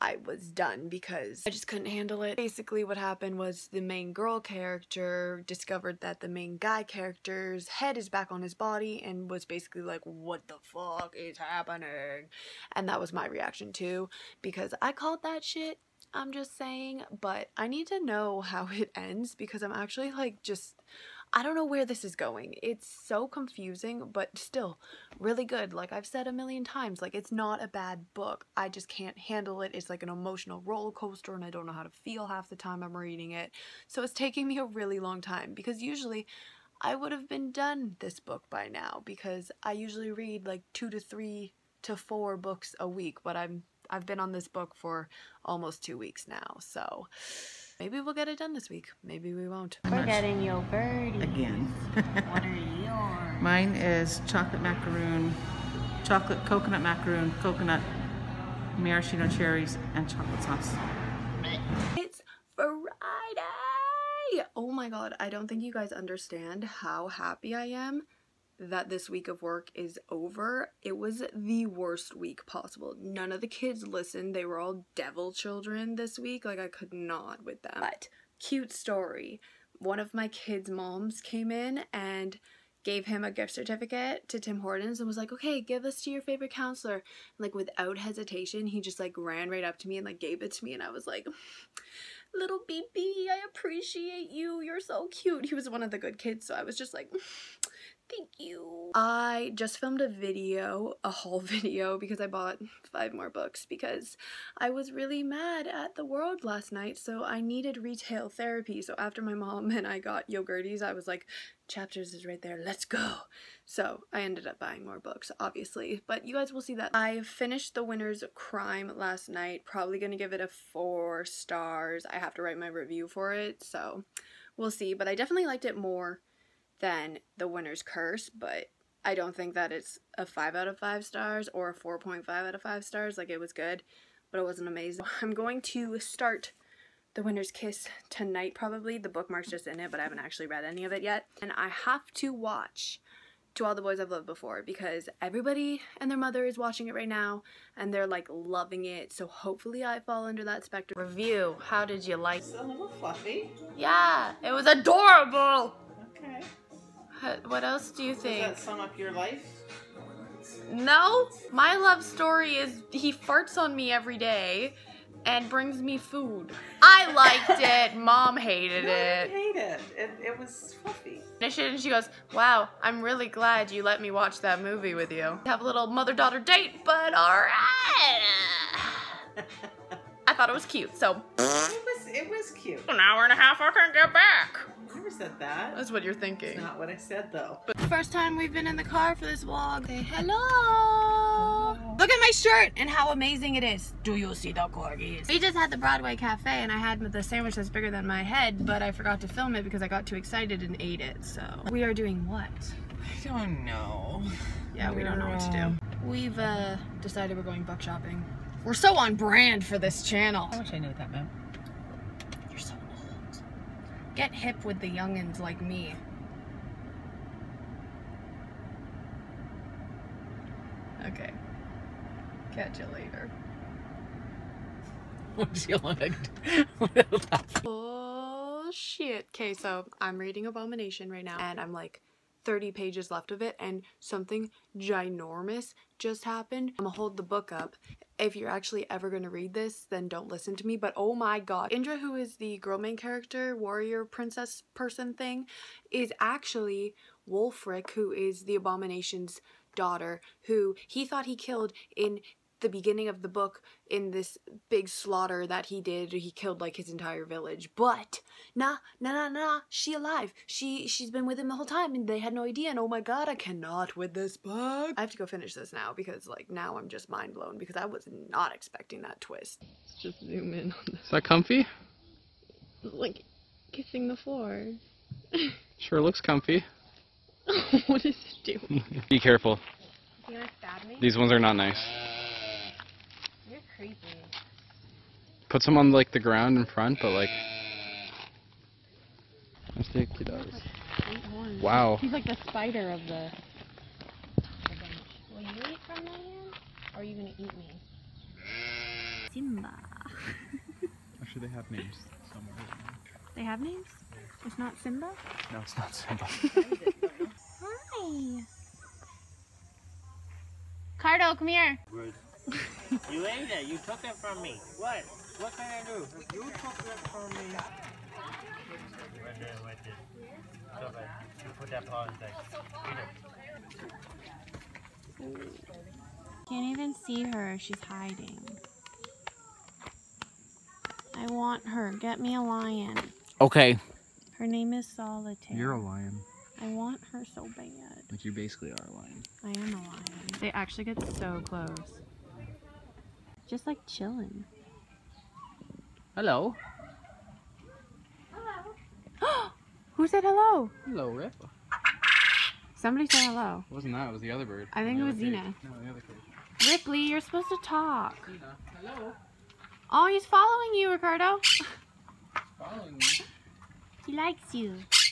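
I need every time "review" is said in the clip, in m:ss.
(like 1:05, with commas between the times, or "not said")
2:02, 2:30.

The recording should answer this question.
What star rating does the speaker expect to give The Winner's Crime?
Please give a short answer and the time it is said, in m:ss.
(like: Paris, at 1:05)
4 stars, at 2:00.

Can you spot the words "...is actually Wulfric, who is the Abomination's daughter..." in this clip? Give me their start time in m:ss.
4:05.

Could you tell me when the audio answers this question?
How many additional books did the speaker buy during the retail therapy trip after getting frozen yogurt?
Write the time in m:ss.
1:42.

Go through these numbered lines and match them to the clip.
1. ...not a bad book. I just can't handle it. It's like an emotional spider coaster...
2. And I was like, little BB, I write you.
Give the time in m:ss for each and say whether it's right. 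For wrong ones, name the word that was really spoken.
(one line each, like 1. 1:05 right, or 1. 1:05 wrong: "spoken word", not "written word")
1. 0:27 wrong: "roller", not "spider"
2. 1:30 wrong: "appreciate", not "write".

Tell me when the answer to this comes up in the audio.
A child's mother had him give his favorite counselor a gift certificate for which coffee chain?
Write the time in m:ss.
1:24.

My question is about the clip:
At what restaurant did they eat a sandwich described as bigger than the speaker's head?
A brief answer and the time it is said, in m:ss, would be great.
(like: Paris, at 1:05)
Broadway Cafe, at 3:15.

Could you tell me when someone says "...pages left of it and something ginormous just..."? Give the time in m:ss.
3:52.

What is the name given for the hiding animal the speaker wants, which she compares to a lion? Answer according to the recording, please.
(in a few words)
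Solitaire.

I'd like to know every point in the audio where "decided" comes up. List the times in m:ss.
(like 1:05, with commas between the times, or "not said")
3:27.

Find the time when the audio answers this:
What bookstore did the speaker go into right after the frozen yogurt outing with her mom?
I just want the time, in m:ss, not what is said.
1:51.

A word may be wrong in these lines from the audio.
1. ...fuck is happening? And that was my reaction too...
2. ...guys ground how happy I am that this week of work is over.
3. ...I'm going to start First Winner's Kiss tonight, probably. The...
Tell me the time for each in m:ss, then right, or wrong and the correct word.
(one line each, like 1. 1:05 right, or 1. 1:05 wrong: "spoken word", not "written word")
1. 0:10 right
2. 1:05 wrong: "understand", not "ground"
3. 2:15 wrong: "The", not "First".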